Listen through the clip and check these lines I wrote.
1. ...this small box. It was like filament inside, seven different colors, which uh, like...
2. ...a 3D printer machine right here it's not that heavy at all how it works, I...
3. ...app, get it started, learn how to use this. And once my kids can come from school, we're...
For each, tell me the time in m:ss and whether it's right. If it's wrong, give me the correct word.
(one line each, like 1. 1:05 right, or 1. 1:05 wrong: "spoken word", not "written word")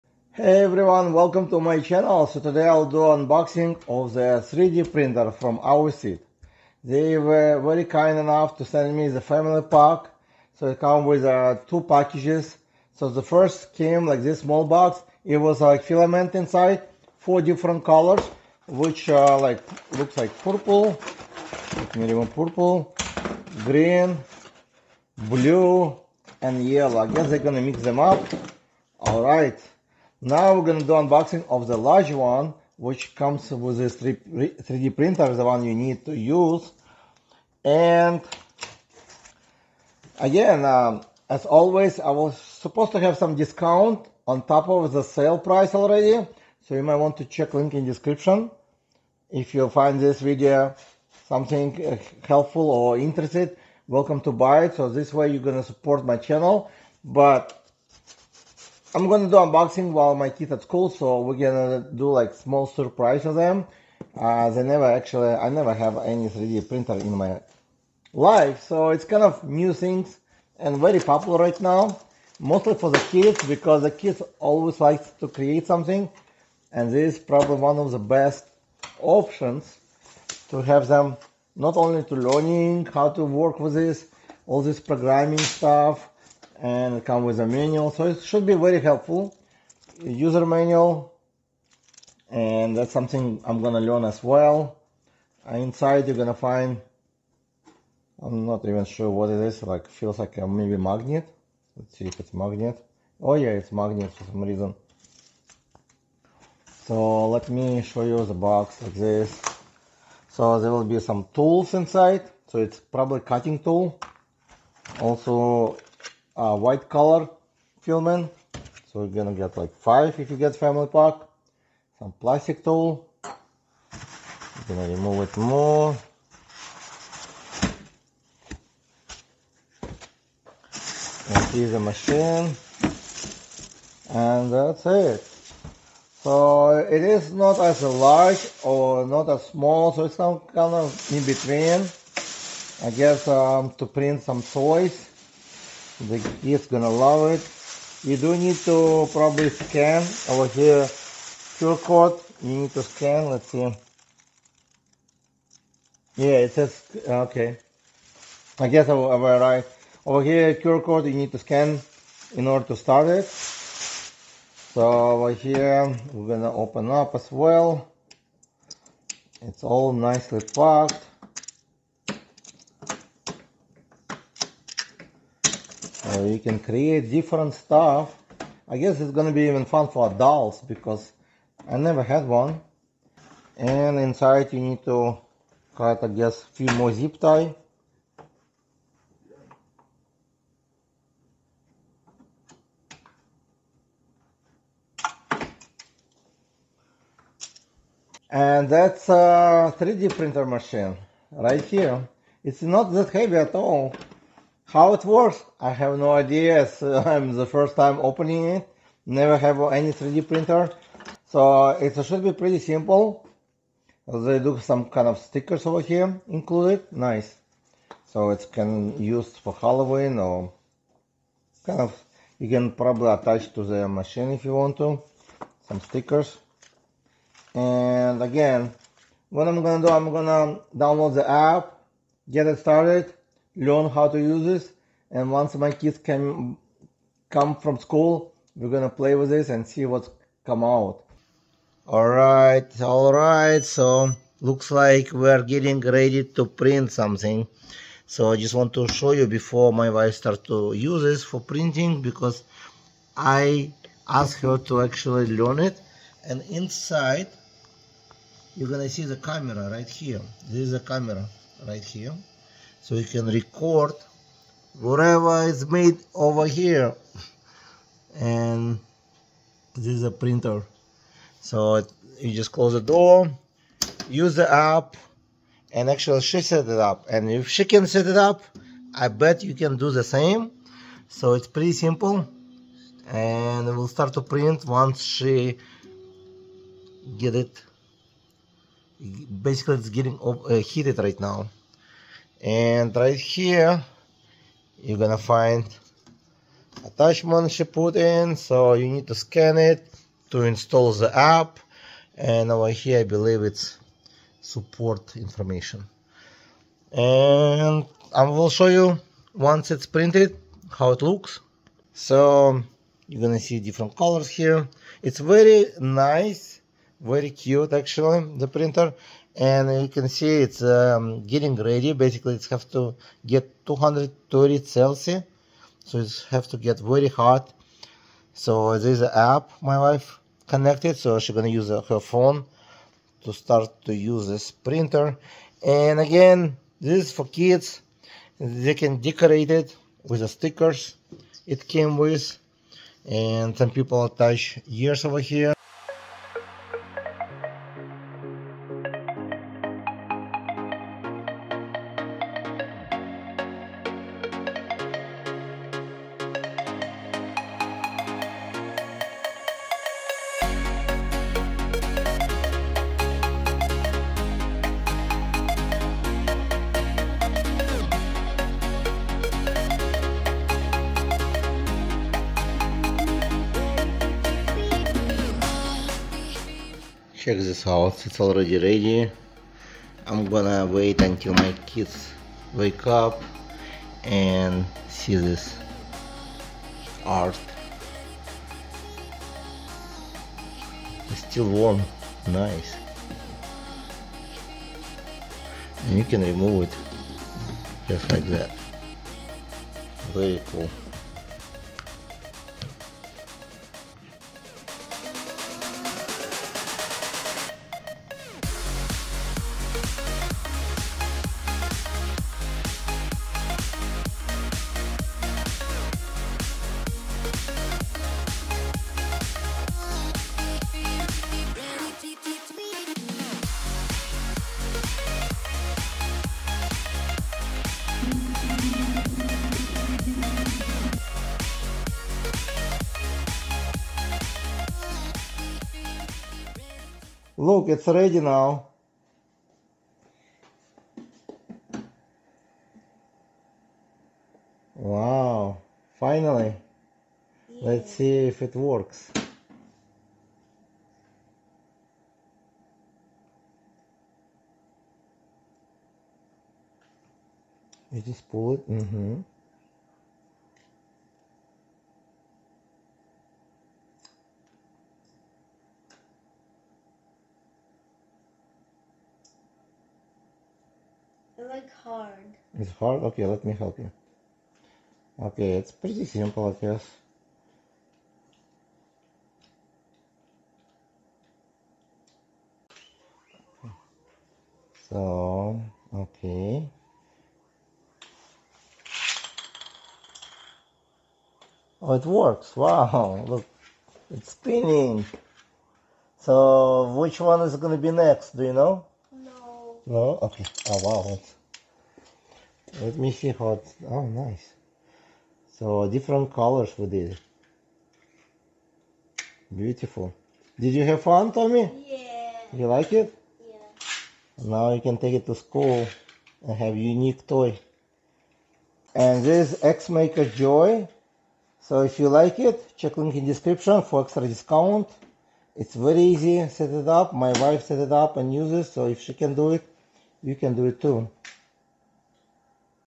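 1. 0:14 wrong: "four", not "seven"
2. 3:19 right
3. 3:51 right.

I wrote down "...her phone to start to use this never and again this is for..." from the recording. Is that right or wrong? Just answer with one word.
wrong.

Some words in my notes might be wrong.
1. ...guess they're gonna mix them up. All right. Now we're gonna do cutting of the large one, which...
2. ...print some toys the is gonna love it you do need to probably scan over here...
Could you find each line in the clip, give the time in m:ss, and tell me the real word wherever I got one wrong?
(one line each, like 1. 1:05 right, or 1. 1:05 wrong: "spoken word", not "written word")
1. 0:27 wrong: "unboxing", not "cutting"
2. 2:23 right.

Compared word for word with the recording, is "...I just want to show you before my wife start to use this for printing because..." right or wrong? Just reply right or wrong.
right.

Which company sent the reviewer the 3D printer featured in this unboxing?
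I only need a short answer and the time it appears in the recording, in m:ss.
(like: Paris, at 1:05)
AOSEED, at 0:05.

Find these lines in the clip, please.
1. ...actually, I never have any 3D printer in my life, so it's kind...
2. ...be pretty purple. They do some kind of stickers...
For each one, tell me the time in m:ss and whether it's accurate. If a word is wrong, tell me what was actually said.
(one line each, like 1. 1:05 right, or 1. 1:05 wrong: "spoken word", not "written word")
1. 1:04 right
2. 3:32 wrong: "simple", not "purple".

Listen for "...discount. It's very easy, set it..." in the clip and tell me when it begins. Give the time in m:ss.
8:44.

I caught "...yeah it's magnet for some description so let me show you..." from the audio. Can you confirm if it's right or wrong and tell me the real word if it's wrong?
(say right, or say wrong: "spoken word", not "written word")
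wrong: "reason", not "description".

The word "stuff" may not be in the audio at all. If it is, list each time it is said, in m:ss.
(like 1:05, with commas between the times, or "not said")
1:25, 2:57.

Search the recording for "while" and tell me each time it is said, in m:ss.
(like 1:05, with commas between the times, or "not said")
0:59.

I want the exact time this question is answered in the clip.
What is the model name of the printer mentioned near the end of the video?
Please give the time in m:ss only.
8:39.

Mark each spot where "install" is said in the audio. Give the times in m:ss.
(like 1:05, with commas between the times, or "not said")
5:00.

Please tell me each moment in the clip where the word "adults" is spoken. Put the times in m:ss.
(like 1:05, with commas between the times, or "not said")
3:00.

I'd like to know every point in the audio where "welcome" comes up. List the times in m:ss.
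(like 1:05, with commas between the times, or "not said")
0:01, 0:53.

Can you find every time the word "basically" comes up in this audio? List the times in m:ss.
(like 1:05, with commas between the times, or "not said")
4:49, 5:21.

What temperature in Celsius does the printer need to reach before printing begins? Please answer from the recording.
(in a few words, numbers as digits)
230.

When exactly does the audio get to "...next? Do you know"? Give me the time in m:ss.
8:17.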